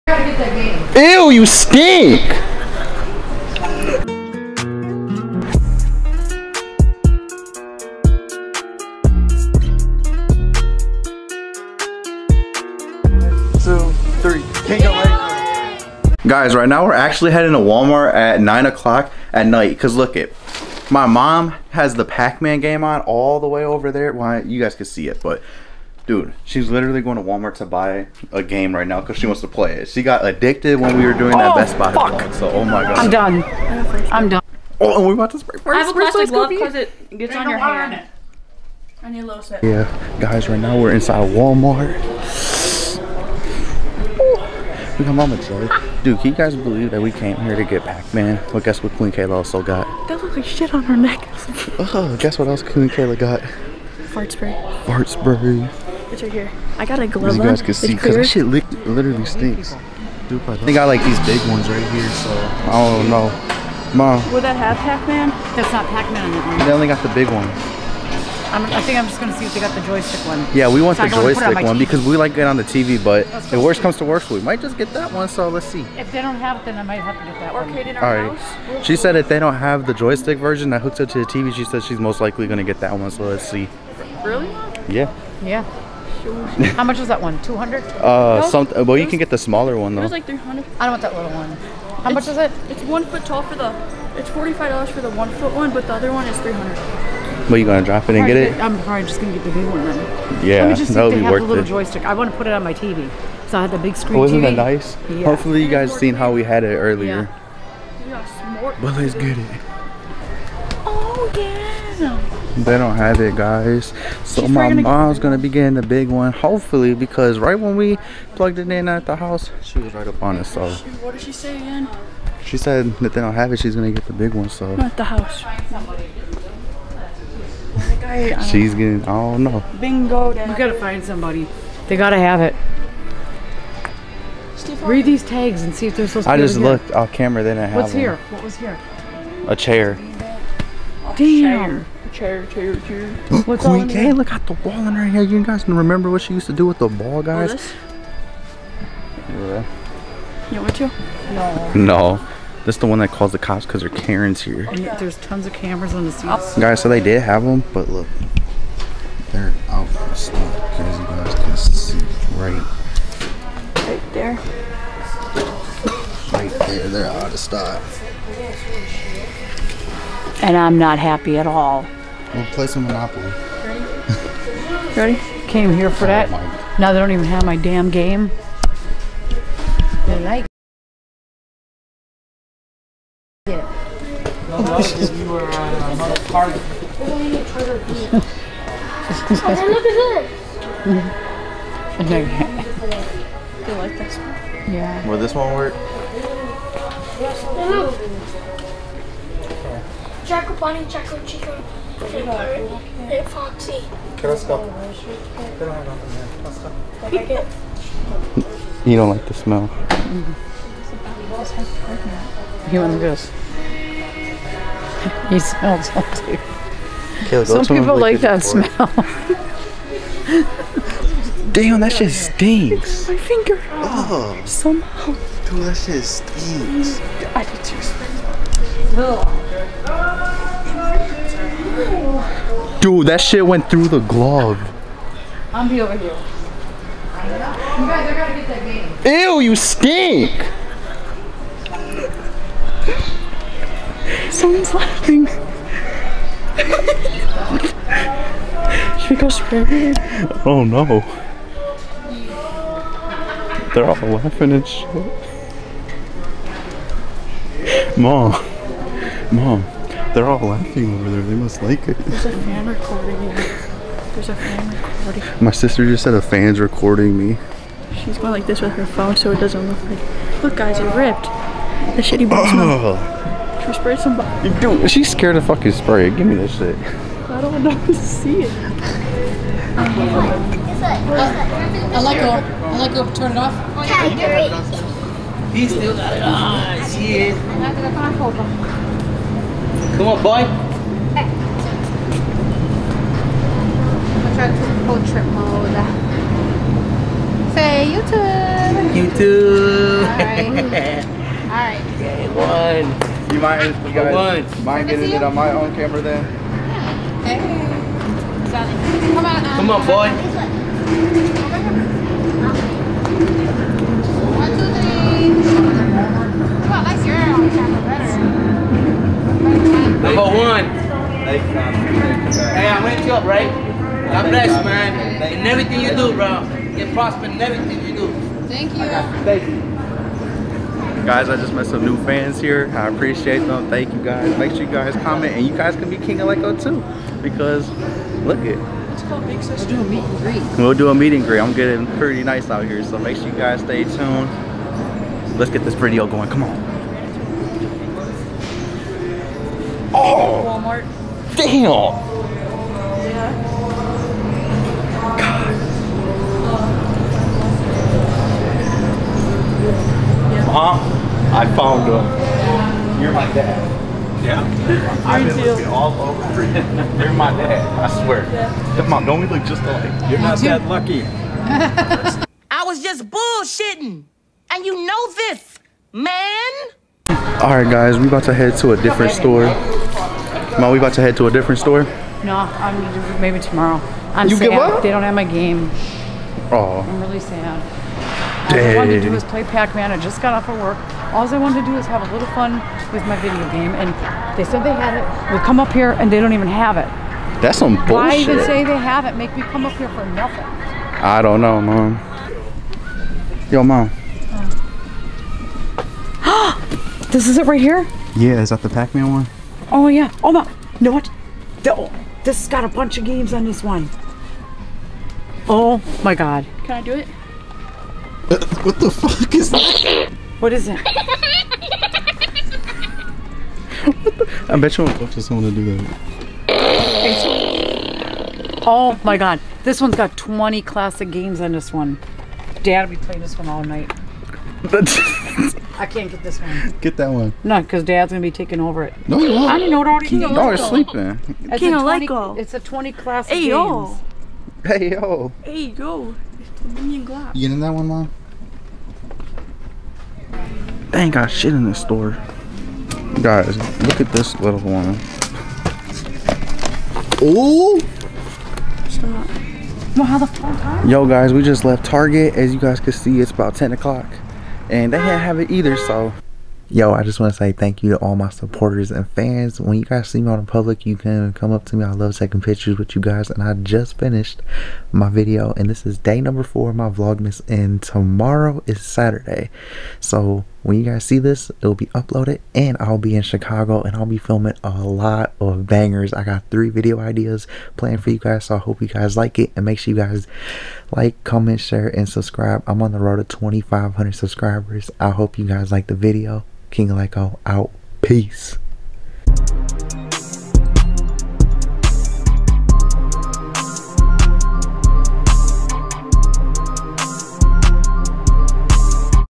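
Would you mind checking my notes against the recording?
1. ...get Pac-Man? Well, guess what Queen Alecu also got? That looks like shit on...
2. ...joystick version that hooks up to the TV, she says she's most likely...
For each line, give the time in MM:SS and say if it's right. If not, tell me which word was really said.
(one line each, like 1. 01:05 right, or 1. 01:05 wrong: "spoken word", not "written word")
1. 00:47 wrong: "Kayla", not "Alecu"
2. 01:19 right.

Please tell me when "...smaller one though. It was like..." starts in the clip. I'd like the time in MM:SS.
01:29.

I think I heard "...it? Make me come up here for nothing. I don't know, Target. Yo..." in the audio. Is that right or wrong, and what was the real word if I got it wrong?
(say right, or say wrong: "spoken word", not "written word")
wrong: "Mom", not "Target".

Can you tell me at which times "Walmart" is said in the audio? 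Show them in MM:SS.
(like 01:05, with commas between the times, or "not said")
00:17, 00:27, 00:41, 05:50.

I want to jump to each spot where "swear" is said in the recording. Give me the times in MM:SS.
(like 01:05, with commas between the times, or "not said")
06:08.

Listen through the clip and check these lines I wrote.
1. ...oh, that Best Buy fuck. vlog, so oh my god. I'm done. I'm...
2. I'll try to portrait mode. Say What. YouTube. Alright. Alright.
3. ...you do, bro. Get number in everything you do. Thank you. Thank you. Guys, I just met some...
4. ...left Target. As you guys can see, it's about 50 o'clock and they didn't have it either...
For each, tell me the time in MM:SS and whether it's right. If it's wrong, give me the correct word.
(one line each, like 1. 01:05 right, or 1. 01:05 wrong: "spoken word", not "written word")
1. 00:31 right
2. 04:54 wrong: "YouTube", not "What"
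3. 05:25 wrong: "prosper", not "number"
4. 07:41 wrong: "10", not "50".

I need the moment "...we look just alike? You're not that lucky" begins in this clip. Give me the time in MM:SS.
06:09.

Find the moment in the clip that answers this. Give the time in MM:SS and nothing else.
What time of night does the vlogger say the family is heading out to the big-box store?
00:18.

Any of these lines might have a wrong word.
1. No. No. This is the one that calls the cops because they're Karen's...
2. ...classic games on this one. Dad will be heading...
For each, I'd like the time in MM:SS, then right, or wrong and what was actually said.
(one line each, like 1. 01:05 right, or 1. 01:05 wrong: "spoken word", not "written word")
1. 02:31 right
2. 07:10 wrong: "playing", not "heading".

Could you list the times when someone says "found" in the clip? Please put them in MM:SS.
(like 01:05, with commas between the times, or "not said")
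06:01.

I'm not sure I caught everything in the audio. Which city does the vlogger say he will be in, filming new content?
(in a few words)
Chicago.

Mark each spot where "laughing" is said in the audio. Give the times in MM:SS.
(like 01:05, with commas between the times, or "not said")
04:04, 04:13, 04:20.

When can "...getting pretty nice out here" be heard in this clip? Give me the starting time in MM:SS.
05:41.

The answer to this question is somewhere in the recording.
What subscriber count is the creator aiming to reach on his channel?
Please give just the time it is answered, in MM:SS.
08:13.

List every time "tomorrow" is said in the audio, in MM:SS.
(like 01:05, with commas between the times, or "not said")
06:23, 07:57.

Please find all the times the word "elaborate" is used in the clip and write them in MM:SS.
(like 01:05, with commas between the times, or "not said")
not said.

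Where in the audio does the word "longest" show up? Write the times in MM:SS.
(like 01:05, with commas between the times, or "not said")
not said.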